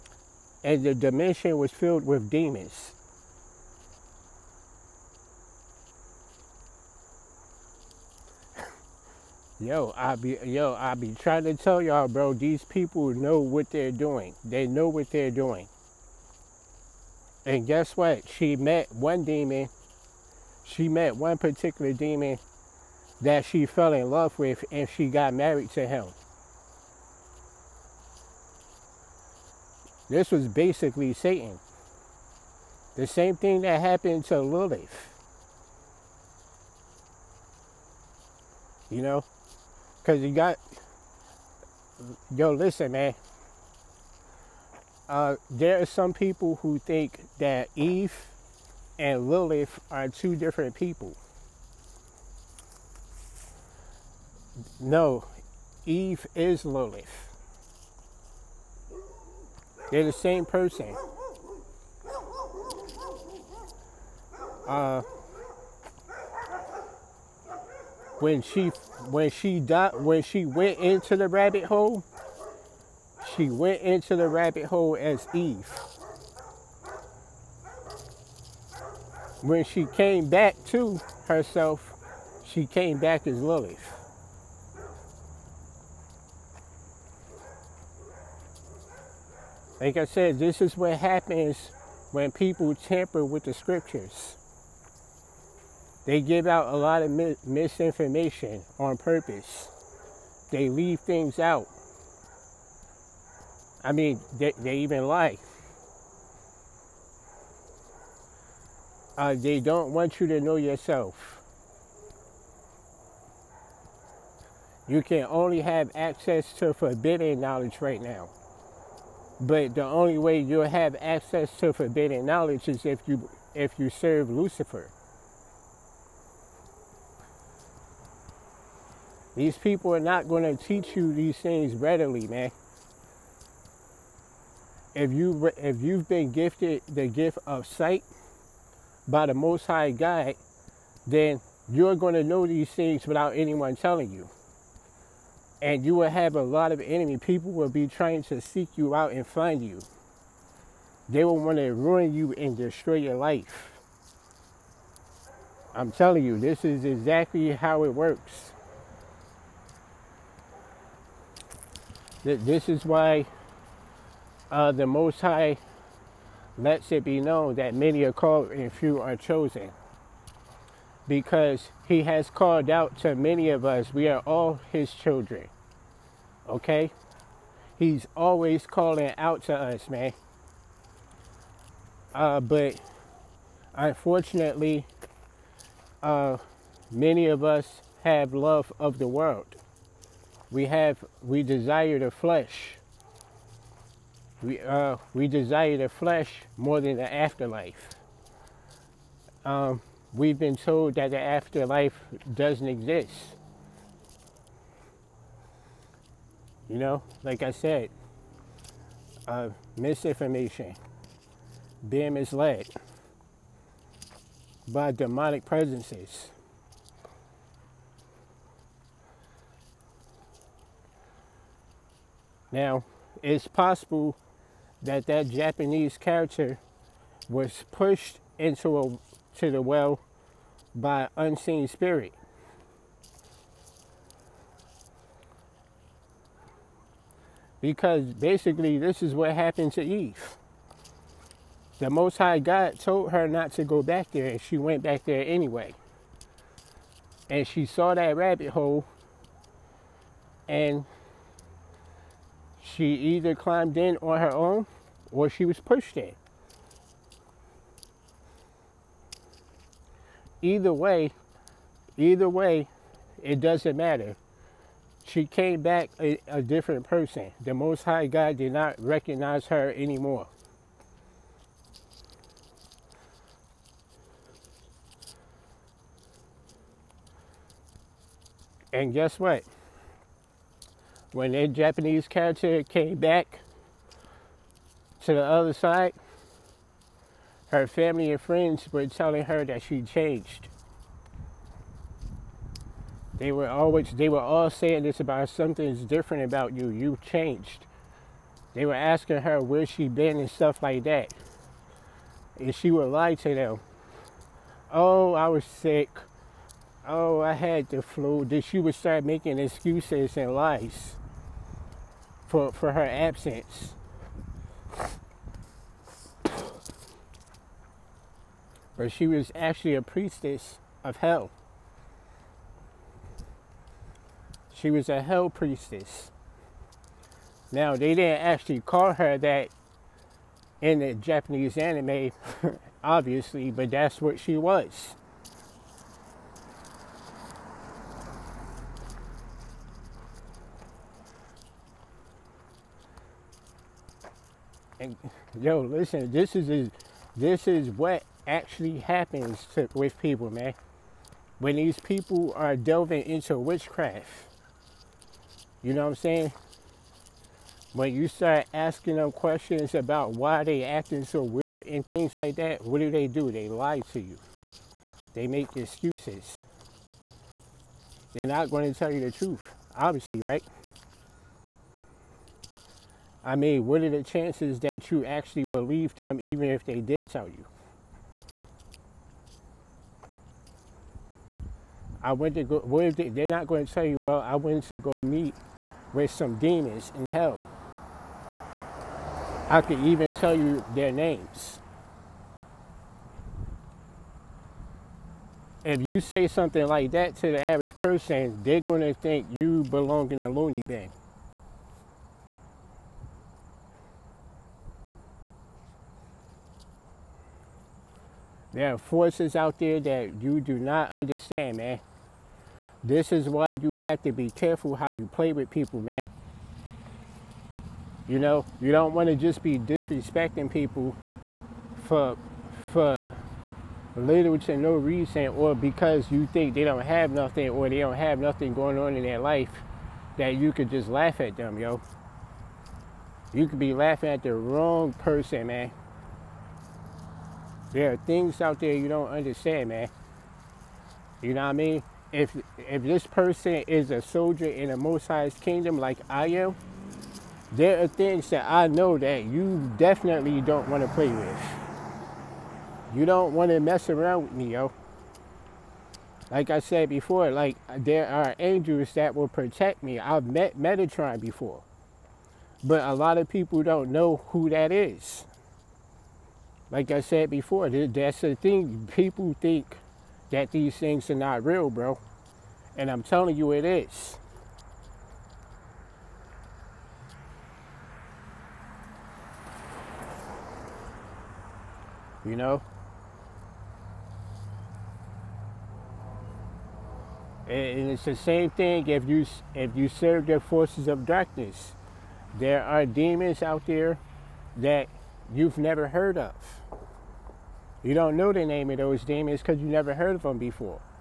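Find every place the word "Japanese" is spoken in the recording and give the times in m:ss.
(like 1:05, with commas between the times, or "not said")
3:45, 4:41, 5:30.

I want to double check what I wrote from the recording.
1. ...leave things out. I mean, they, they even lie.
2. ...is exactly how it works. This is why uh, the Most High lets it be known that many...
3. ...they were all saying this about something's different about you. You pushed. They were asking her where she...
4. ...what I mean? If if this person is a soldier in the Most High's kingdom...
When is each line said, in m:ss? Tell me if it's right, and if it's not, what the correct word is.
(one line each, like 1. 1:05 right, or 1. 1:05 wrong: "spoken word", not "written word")
1. 1:40 right
2. 2:36 right
3. 4:53 wrong: "changed", not "pushed"
4. 7:21 right.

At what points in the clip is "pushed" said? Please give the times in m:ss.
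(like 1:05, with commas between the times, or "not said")
3:47, 4:15.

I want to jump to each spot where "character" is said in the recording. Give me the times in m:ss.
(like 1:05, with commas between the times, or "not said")
3:45, 4:42.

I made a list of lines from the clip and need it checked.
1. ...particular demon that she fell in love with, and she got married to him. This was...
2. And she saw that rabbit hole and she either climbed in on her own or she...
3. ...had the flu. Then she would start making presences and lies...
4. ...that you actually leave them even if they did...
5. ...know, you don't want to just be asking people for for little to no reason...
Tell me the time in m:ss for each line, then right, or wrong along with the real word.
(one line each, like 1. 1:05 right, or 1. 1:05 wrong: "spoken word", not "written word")
1. 0:21 right
2. 4:07 right
3. 5:07 wrong: "excuses", not "presences"
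4. 6:14 wrong: "believe", not "leave"
5. 6:58 wrong: "disrespecting", not "asking".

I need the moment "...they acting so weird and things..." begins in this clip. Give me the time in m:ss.
6:00.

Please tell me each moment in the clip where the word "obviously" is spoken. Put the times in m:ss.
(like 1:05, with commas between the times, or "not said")
5:32, 6:09.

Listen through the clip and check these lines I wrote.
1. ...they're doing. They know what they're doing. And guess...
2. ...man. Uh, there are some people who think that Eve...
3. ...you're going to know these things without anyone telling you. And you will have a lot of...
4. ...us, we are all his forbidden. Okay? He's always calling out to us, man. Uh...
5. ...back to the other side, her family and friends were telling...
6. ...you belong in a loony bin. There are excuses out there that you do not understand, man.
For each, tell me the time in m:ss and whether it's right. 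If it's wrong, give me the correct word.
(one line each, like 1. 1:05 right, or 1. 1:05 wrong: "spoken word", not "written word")
1. 0:13 right
2. 0:42 right
3. 2:21 right
4. 2:53 wrong: "children", not "forbidden"
5. 4:42 right
6. 6:39 wrong: "forces", not "excuses".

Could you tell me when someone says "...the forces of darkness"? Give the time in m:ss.
8:10.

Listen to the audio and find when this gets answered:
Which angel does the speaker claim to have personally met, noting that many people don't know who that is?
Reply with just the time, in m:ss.
7:40.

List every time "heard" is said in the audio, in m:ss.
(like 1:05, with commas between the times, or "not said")
8:15, 8:19.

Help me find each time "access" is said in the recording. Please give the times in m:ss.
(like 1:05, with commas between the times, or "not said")
1:55, 2:00.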